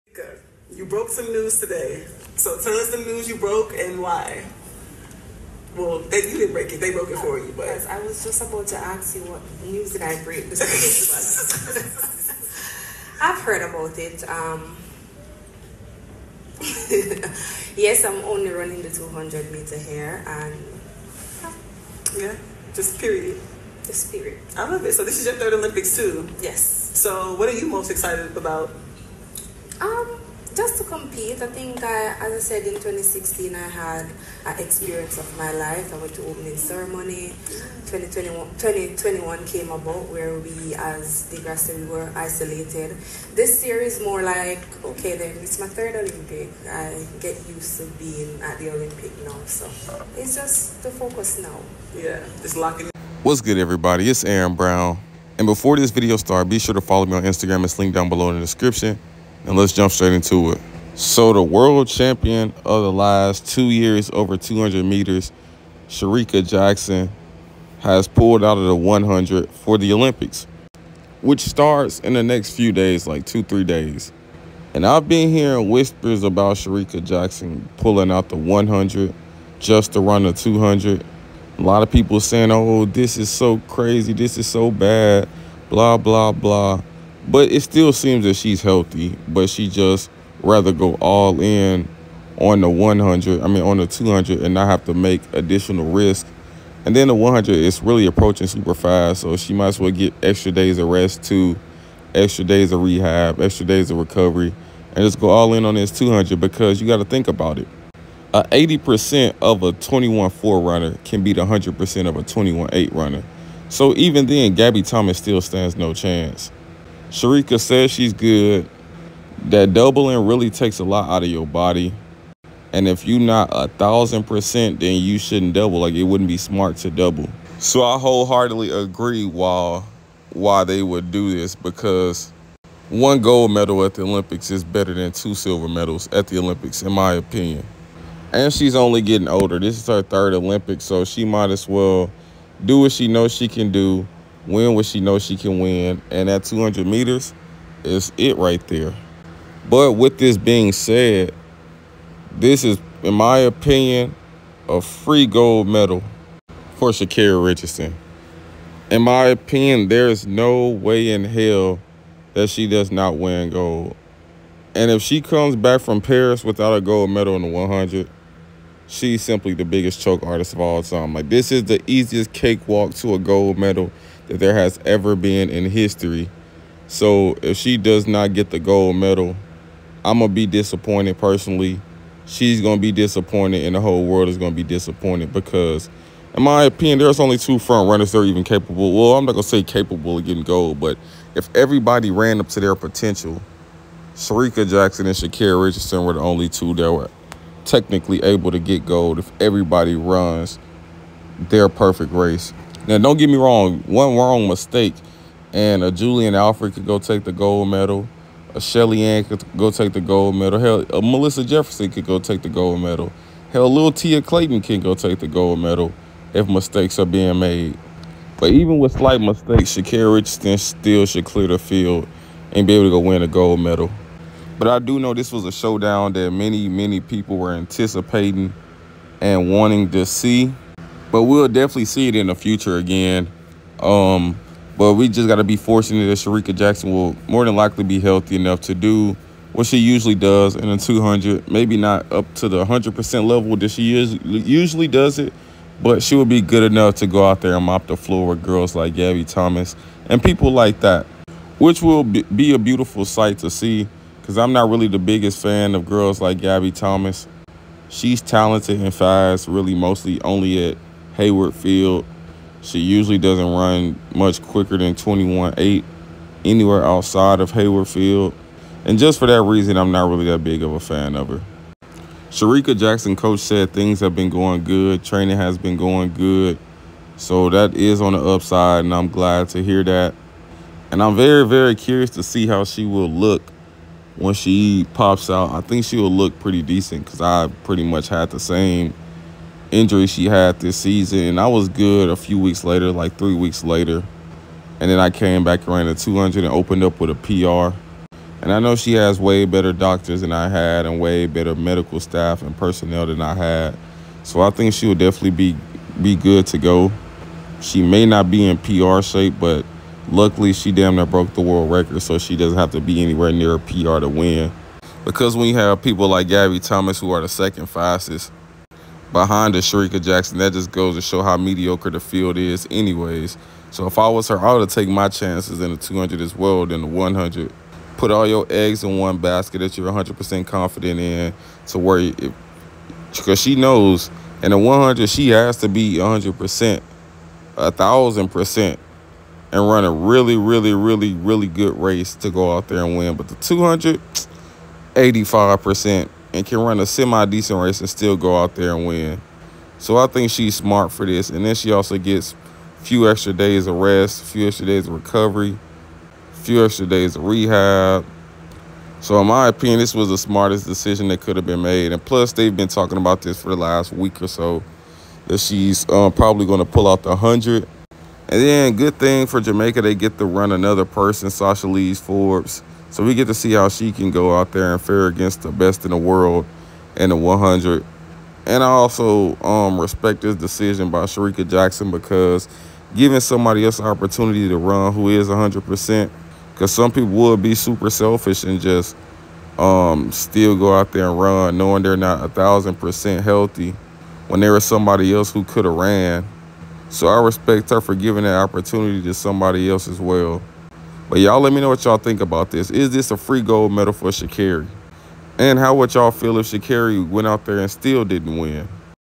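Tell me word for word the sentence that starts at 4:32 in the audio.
Shericka Jackson coach said things have been going good.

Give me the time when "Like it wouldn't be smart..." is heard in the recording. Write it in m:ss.
2:05.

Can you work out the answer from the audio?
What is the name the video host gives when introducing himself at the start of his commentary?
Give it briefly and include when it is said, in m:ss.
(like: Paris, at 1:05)
Erin Brown, at 0:54.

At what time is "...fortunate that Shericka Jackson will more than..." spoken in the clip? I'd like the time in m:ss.
3:55.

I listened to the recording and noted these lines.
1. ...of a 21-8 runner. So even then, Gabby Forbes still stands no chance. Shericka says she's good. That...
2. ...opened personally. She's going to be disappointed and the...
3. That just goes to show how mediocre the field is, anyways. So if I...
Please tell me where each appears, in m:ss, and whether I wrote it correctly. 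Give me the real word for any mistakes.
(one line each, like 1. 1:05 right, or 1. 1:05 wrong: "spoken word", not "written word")
1. 1:52 wrong: "Thomas", not "Forbes"
2. 3:00 wrong: "disappointed", not "opened"
3. 5:20 right.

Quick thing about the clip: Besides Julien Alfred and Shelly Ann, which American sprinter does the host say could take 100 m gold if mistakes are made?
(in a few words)
Melissa Jefferson.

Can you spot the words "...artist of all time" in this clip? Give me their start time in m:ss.
2:50.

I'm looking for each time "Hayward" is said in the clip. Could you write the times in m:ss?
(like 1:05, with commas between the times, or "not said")
4:21, 4:27.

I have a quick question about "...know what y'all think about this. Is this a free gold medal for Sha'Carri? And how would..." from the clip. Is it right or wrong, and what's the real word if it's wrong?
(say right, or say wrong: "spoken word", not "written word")
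right.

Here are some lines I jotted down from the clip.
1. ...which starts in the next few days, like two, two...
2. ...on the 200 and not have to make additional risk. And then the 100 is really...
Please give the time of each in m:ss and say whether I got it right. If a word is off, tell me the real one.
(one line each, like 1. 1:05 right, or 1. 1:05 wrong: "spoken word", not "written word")
1. 1:11 wrong: "three", not "two"
2. 1:33 right.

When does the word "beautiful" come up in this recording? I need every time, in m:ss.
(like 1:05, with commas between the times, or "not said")
4:12.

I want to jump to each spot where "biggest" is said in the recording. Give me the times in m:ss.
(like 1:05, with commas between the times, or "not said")
2:49, 4:14.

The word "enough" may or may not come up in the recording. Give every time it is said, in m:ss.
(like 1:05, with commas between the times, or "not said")
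3:58, 4:06.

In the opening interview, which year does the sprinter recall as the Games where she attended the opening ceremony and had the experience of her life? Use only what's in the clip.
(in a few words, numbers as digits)
2016.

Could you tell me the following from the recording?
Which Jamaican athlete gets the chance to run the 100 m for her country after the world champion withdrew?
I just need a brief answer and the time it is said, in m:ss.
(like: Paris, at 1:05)
Sashalee Forbes, at 6:11.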